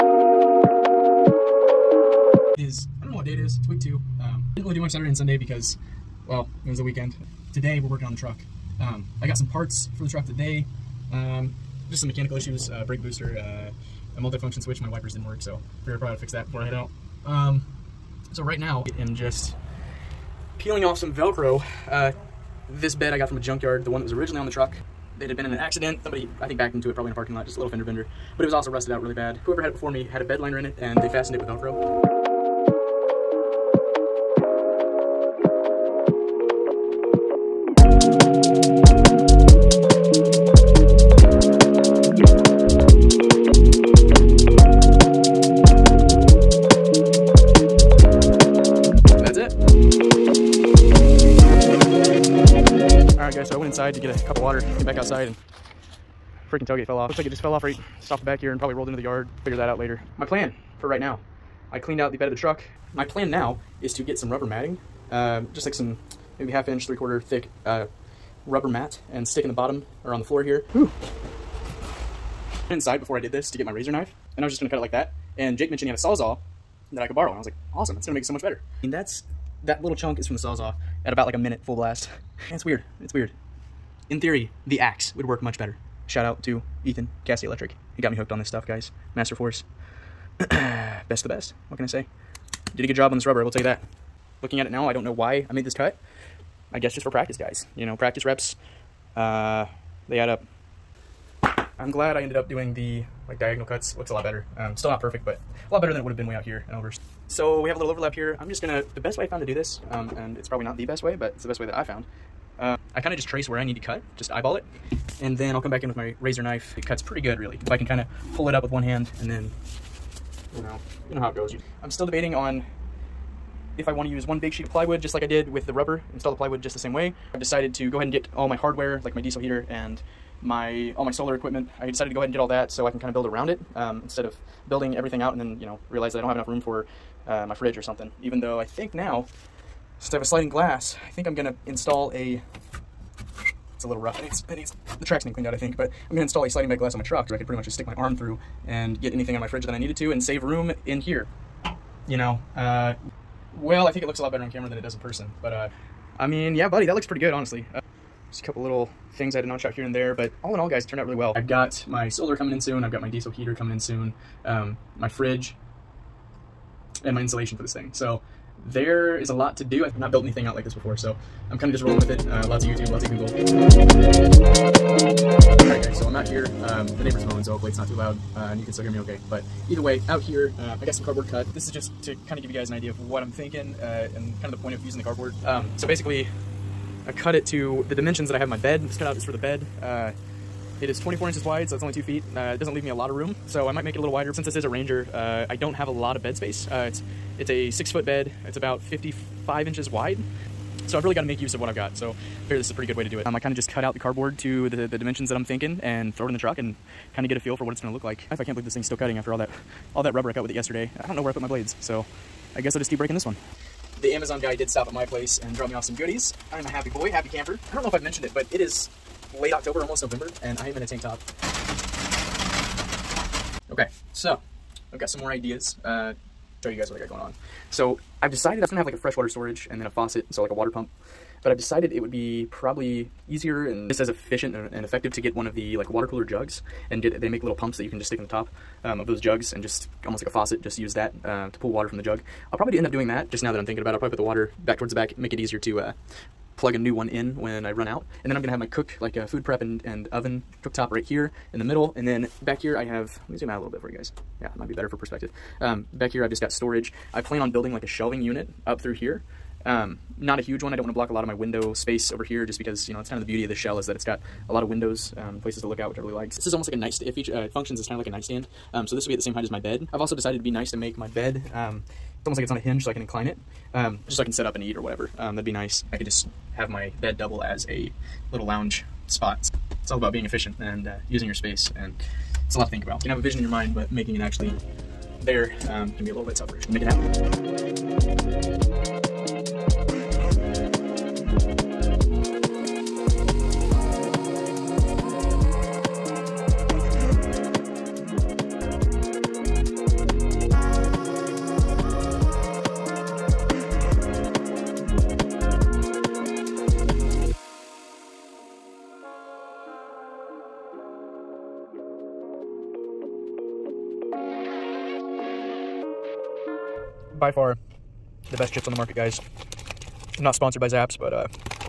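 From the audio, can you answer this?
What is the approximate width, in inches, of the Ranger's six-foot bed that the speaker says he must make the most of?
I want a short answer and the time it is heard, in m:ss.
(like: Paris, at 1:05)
55 inches, at 3:18.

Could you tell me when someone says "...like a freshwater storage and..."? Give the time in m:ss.
3:48.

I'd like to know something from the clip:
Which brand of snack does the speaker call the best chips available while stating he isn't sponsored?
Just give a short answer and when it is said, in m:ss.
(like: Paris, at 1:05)
Zapp's, at 5:20.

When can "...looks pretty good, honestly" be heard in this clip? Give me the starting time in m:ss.
2:36.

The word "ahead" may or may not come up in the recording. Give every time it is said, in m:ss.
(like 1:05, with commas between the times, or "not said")
2:07, 2:12.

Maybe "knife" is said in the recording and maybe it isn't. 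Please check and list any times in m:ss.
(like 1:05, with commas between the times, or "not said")
1:13, 1:56.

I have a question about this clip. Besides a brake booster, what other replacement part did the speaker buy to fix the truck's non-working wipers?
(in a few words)
multifunction switch.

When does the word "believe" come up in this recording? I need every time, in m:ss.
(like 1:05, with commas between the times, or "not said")
3:28.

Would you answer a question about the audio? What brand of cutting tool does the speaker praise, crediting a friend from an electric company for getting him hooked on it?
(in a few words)
Master Force.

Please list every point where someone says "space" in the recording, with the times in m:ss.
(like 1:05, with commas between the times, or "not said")
3:16, 4:21, 4:41.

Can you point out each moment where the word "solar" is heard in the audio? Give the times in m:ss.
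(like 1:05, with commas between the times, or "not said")
2:11, 2:42.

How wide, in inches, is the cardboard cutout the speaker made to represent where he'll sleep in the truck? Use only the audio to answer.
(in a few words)
24 inches.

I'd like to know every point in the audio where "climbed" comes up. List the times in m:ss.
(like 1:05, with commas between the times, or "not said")
not said.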